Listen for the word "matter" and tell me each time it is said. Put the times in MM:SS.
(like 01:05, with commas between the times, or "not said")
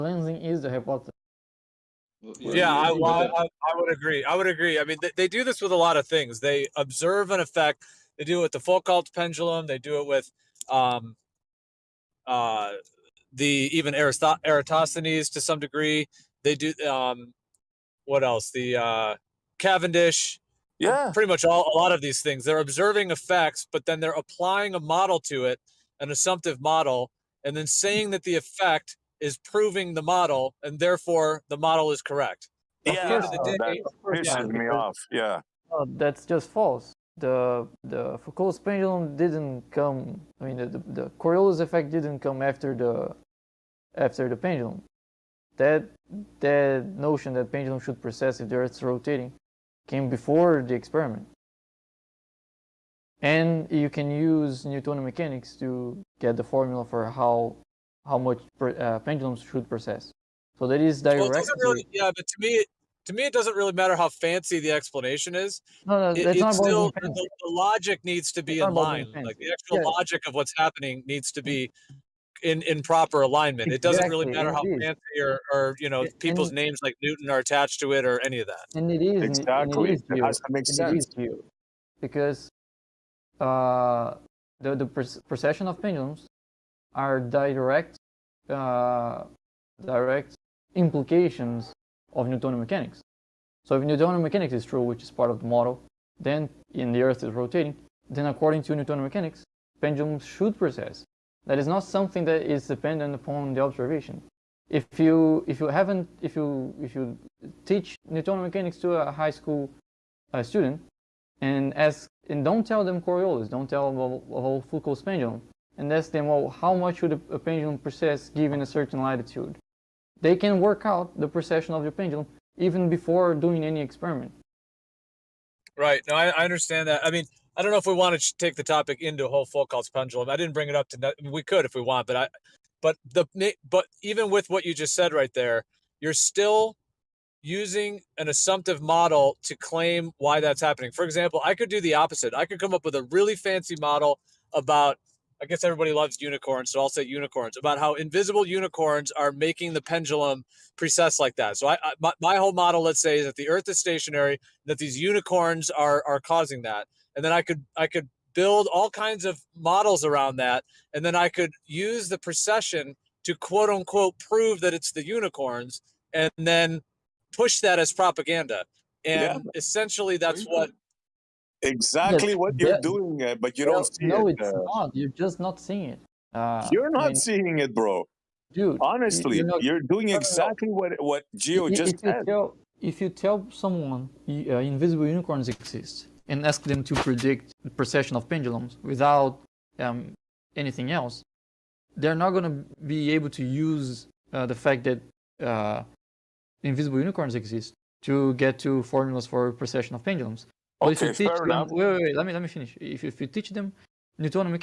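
01:03, 01:14.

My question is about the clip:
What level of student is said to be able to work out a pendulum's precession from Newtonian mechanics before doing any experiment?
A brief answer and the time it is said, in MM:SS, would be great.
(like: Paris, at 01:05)
High school, at 01:49.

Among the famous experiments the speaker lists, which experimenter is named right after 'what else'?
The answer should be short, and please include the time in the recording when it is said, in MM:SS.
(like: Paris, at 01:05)
Cavendish, at 00:19.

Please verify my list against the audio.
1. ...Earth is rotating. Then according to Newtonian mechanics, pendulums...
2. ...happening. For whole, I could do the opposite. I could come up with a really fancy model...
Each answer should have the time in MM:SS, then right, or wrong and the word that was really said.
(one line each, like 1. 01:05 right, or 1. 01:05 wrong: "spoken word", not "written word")
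1. 01:37 right
2. 02:20 wrong: "example", not "whole".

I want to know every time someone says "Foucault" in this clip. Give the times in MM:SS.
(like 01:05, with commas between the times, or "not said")
00:08, 00:38, 01:54, 02:09.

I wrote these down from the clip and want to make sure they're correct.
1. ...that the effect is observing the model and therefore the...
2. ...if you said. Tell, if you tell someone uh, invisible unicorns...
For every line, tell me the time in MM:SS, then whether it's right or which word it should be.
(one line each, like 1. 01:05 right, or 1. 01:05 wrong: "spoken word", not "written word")
1. 00:28 wrong: "proving", not "observing"
2. 03:01 right.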